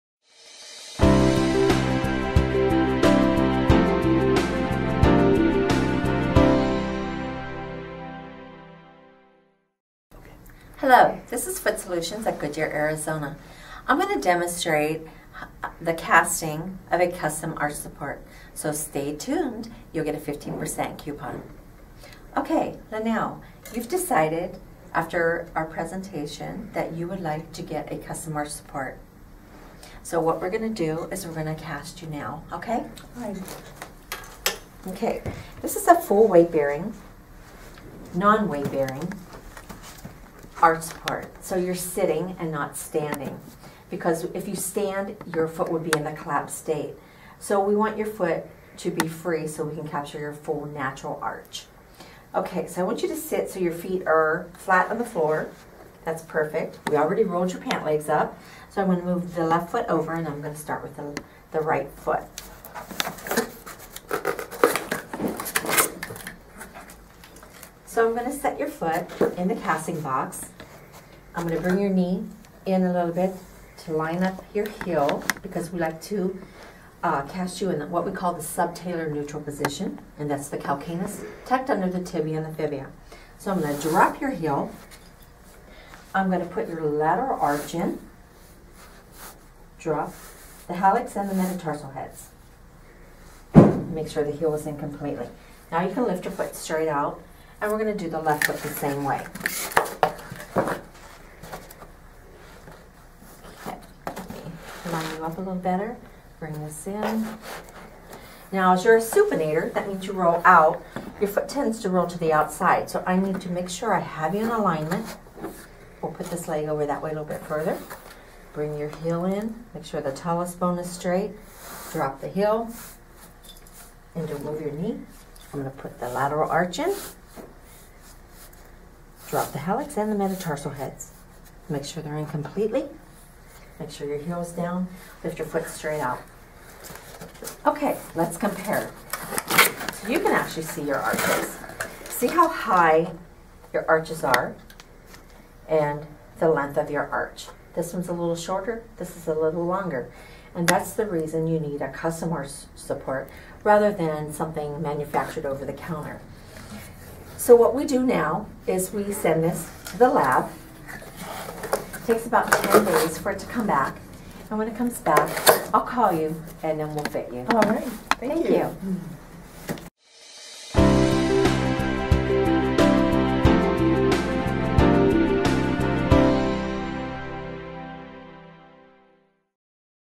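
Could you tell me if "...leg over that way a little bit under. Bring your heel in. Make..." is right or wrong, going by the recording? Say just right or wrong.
wrong.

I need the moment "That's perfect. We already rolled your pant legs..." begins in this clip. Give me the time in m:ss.
0:56.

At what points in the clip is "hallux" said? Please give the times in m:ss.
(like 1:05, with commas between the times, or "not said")
1:30, 2:09.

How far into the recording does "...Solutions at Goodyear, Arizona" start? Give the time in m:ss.
0:11.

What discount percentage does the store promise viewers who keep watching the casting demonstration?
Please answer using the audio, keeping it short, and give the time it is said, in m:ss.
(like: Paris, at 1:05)
15%, at 0:20.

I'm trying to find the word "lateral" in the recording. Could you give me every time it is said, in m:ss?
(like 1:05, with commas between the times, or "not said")
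1:26, 2:06.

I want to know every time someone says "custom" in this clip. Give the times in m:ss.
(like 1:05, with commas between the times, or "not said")
0:17, 0:27, 2:31.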